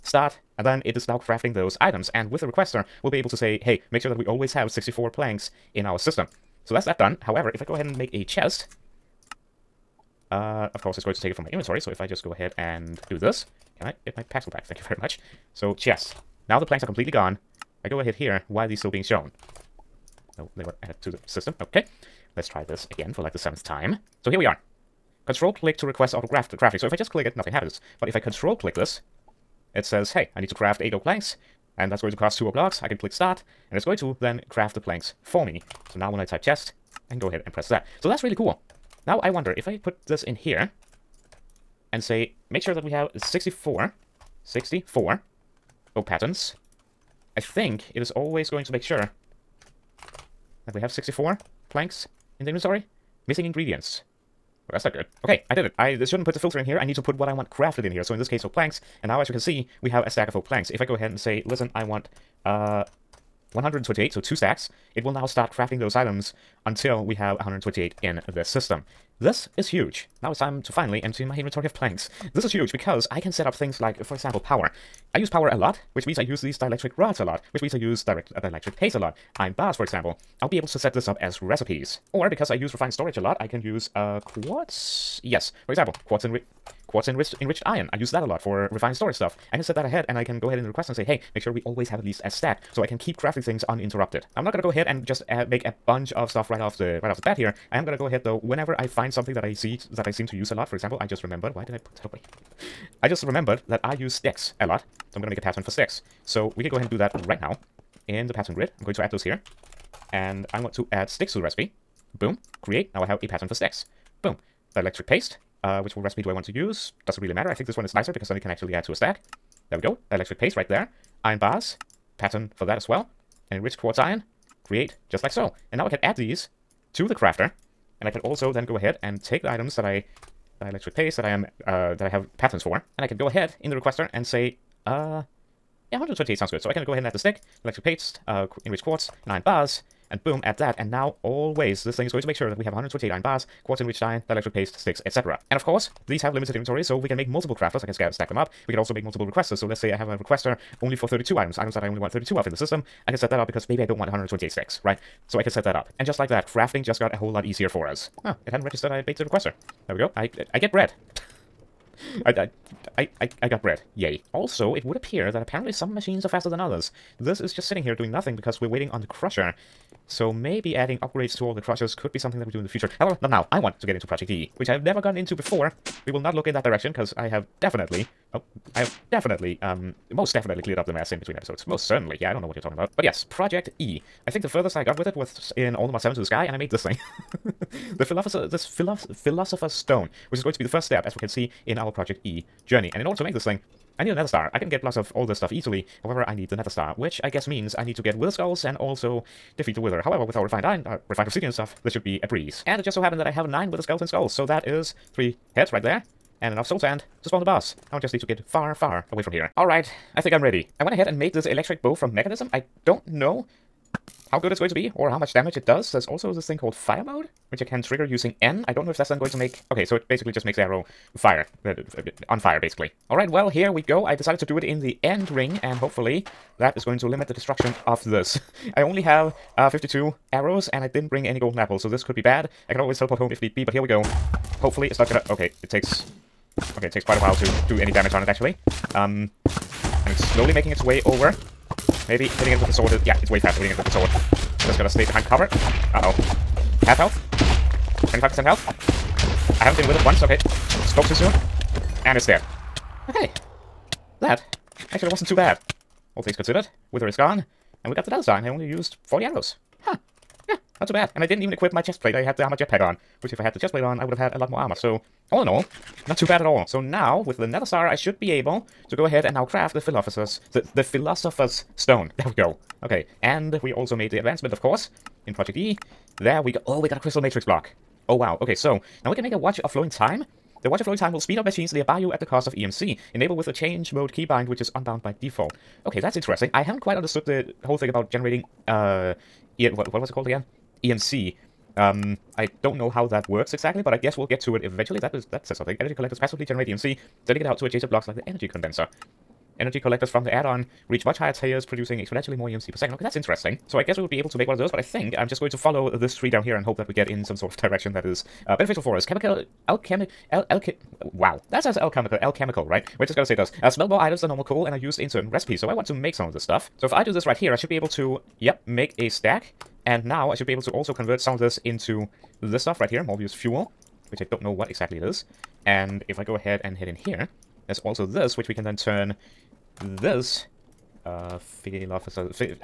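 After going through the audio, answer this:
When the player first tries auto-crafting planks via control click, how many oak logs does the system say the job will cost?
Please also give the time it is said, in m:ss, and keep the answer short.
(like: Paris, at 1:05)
2, at 0:32.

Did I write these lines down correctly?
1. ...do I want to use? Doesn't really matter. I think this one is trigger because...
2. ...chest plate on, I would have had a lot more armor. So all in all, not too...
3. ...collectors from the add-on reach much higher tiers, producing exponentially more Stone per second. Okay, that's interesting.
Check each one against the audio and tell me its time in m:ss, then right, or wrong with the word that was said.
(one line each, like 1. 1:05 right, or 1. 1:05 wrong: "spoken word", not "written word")
1. 1:56 wrong: "nicer", not "trigger"
2. 4:23 right
3. 4:59 wrong: "EMC", not "Stone".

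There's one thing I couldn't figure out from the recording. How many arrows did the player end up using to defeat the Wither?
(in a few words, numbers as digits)
40.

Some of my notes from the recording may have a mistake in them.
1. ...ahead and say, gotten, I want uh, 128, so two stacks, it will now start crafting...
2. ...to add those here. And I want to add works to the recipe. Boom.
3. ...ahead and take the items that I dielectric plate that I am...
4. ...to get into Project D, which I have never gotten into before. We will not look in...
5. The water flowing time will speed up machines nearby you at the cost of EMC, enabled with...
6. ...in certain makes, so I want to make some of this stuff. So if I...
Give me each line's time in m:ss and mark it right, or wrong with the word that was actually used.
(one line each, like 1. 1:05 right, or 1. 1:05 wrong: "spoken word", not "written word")
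1. 1:00 wrong: "listen", not "gotten"
2. 1:48 wrong: "sticks", not "works"
3. 2:08 wrong: "paste", not "plate"
4. 2:53 right
5. 4:40 right
6. 5:14 wrong: "recipes", not "makes".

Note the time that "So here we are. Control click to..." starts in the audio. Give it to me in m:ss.
0:24.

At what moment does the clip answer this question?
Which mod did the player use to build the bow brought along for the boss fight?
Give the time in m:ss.
3:32.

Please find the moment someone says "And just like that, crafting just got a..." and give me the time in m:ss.
2:35.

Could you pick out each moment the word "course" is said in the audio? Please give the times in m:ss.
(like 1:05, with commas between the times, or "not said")
0:10, 2:25, 4:34.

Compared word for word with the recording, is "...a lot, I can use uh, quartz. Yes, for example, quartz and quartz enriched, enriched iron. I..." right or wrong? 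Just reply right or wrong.
right.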